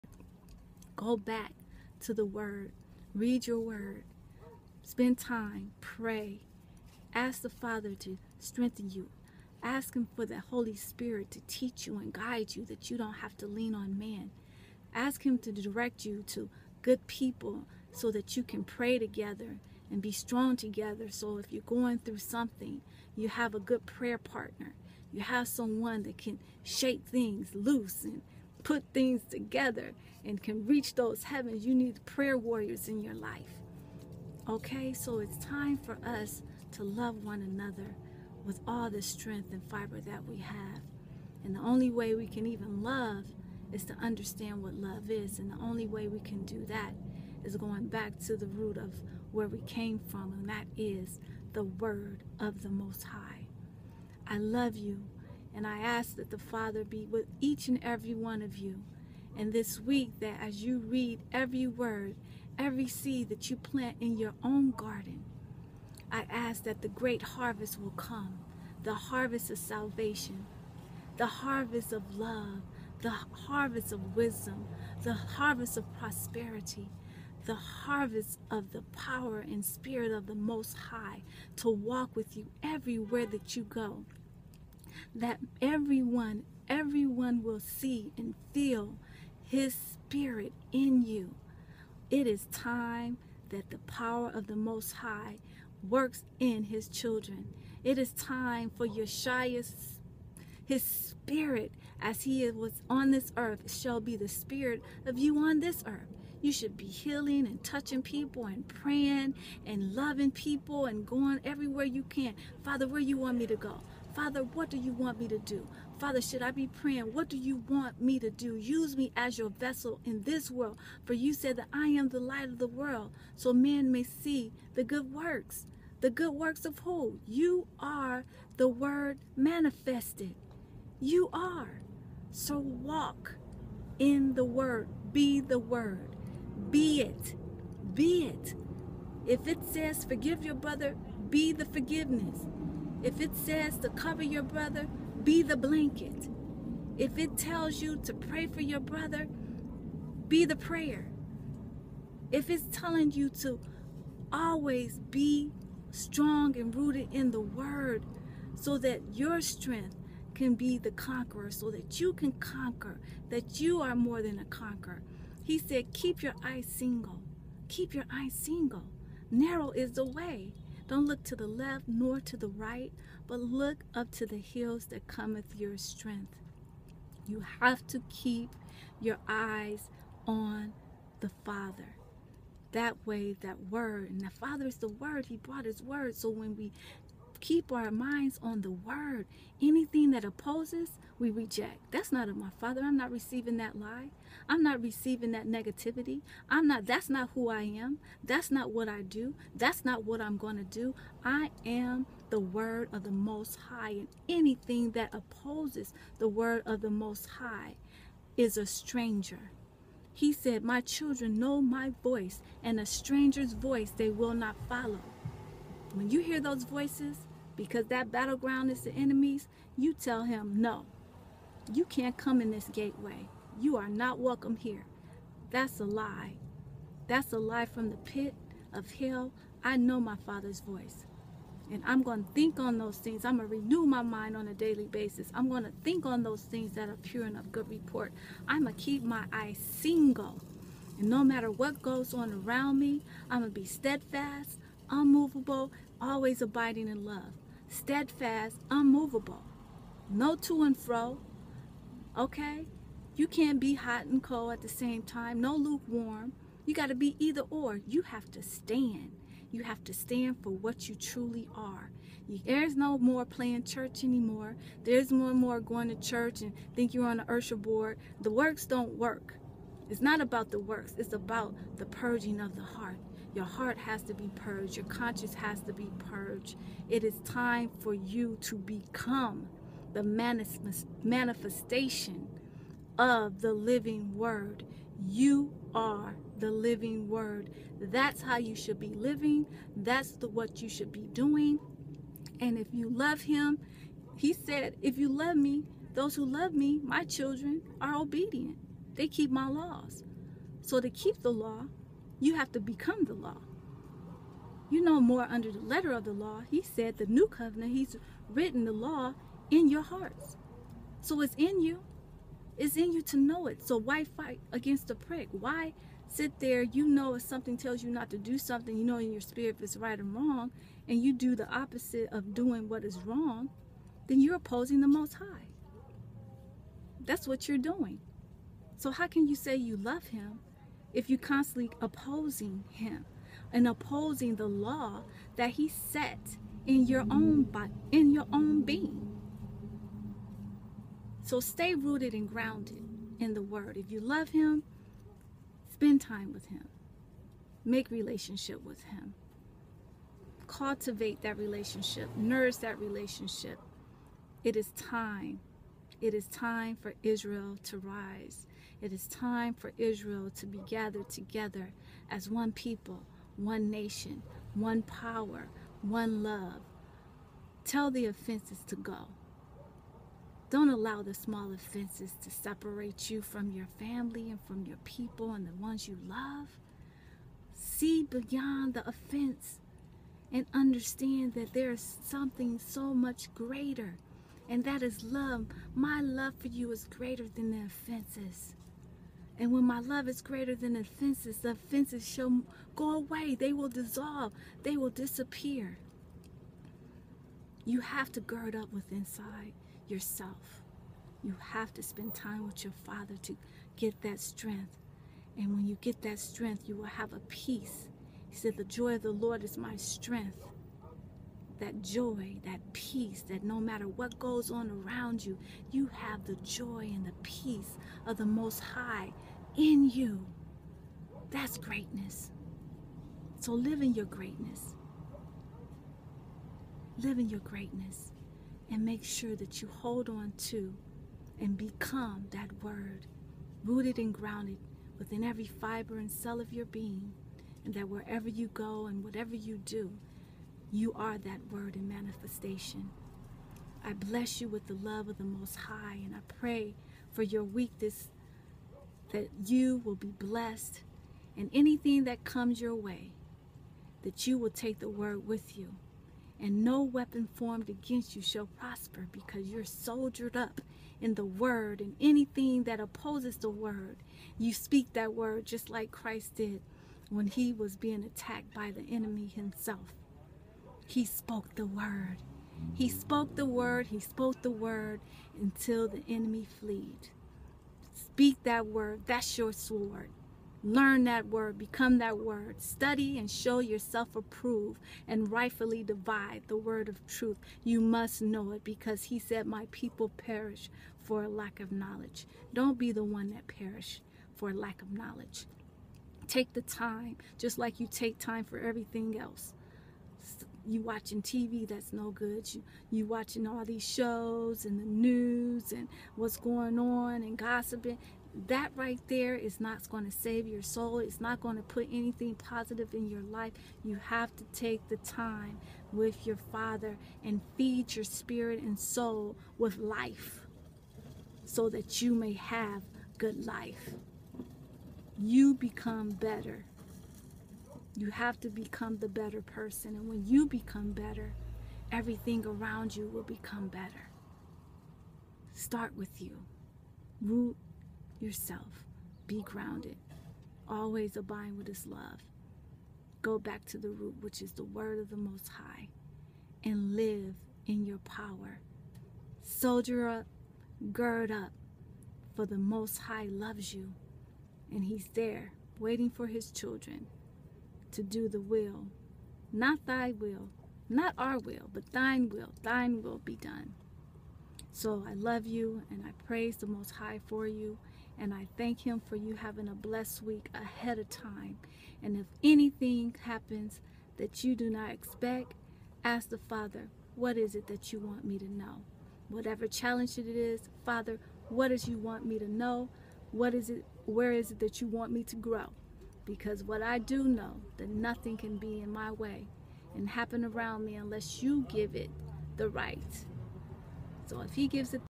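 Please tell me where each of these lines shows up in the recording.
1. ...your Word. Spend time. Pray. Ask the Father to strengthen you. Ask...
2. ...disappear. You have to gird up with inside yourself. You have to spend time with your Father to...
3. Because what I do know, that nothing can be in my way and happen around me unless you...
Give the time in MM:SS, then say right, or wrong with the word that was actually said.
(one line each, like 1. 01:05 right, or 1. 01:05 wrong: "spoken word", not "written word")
1. 00:03 right
2. 06:34 right
3. 09:46 right.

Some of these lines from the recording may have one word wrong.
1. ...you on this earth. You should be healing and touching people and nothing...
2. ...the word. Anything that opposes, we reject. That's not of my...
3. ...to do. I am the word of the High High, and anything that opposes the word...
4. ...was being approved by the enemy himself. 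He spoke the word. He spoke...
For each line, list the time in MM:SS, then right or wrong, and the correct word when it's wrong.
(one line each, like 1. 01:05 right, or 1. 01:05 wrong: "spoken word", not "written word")
1. 01:45 wrong: "praying", not "nothing"
2. 03:08 right
3. 03:20 wrong: "Most", not "High"
4. 07:47 wrong: "attacked", not "approved".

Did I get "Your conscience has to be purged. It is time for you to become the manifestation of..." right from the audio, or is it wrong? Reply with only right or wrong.
right.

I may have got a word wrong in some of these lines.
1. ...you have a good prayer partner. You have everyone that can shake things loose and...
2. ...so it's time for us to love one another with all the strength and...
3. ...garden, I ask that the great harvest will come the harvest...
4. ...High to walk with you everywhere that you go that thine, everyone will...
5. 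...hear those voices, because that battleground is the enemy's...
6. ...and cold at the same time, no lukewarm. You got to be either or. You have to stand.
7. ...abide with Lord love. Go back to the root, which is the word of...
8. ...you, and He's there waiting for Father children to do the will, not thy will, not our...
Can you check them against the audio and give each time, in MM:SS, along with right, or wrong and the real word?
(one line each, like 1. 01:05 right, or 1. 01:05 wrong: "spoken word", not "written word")
1. 00:23 wrong: "someone", not "everyone"
2. 00:34 right
3. 01:04 right
4. 01:20 wrong: "everyone", not "thine"
5. 03:36 right
6. 04:14 right
7. 09:01 wrong: "His", not "Lord"
8. 09:13 wrong: "His", not "Father".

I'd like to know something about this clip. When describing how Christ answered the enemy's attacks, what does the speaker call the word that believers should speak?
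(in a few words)
your sword.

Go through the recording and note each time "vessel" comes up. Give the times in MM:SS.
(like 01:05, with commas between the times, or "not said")
01:59.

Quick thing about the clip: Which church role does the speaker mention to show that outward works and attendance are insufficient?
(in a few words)
usher board.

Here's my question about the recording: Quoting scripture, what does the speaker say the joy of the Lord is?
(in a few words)
my strength.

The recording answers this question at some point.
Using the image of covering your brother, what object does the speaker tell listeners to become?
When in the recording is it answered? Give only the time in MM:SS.
02:25.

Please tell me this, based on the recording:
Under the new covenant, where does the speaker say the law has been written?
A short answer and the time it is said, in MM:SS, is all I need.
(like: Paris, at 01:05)
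in your hearts, at 05:09.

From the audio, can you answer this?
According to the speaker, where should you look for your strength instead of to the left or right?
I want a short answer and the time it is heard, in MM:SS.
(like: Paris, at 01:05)
the hills, at 02:54.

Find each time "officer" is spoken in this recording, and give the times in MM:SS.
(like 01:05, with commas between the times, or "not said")
not said.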